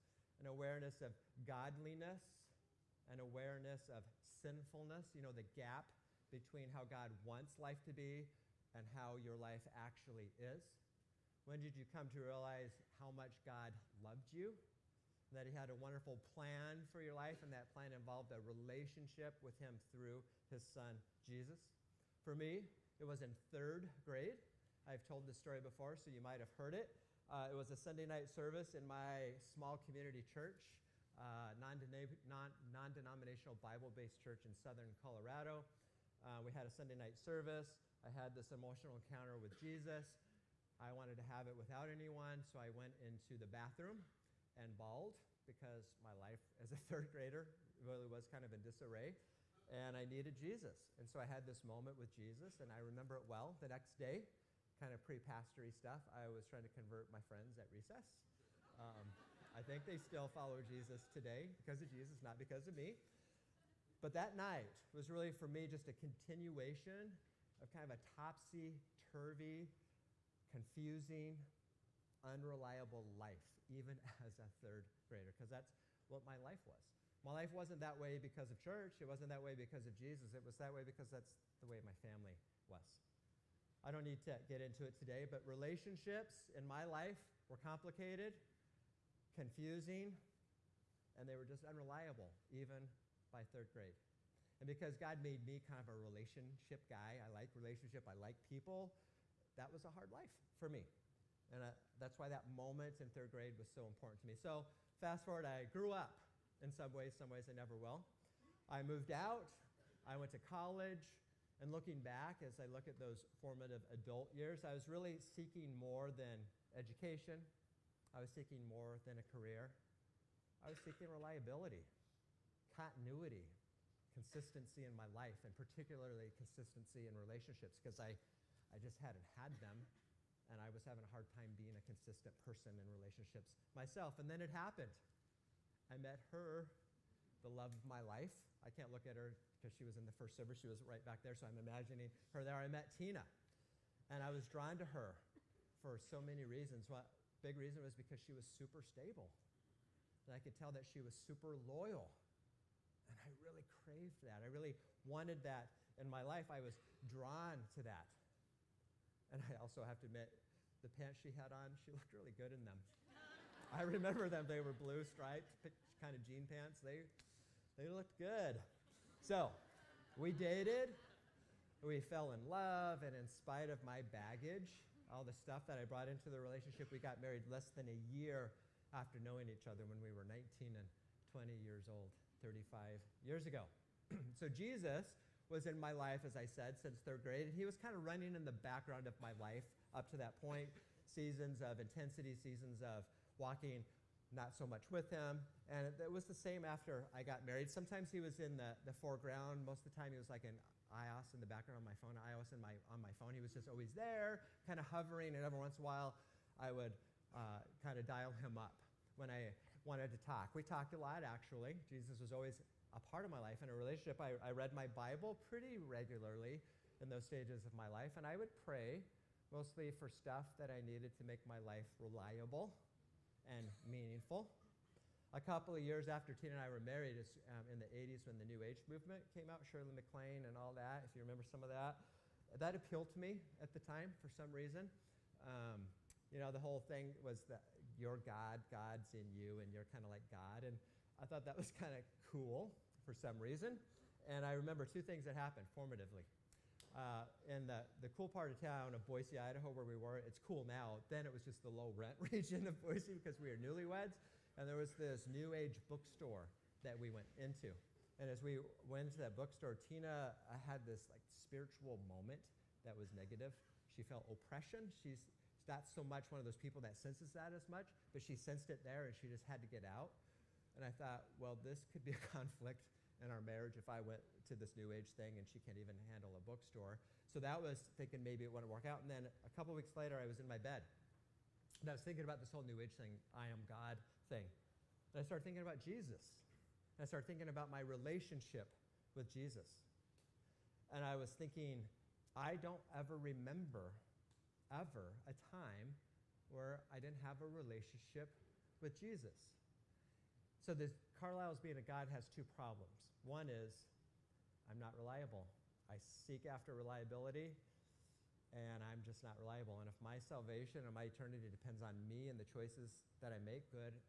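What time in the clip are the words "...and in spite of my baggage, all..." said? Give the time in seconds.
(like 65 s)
173 s.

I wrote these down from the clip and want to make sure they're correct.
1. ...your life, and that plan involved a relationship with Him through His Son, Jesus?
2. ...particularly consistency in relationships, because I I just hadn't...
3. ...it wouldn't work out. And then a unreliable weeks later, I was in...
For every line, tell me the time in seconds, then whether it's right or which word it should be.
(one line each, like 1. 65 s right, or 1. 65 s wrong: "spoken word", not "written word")
1. 16 s right
2. 125 s right
3. 278 s wrong: "couple", not "unreliable".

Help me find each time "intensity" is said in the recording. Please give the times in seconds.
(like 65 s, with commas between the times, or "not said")
191 s.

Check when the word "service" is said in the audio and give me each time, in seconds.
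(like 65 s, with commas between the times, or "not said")
28 s, 37 s, 140 s.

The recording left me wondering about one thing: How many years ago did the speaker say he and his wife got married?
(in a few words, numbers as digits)
35.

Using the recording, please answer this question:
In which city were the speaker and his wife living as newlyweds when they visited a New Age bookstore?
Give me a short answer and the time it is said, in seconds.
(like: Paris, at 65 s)
Boise, Idaho, at 249 s.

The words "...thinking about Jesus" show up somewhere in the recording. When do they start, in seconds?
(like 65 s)
285 s.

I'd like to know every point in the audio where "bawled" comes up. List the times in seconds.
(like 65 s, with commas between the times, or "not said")
44 s.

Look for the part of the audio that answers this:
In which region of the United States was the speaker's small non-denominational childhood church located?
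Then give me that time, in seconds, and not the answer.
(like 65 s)
34 s.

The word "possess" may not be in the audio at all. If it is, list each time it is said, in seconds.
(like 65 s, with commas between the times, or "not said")
not said.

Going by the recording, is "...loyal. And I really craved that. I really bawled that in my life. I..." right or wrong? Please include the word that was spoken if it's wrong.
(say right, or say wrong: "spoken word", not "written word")
wrong: "wanted", not "bawled".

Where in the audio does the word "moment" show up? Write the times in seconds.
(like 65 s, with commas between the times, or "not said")
51 s, 102 s, 262 s.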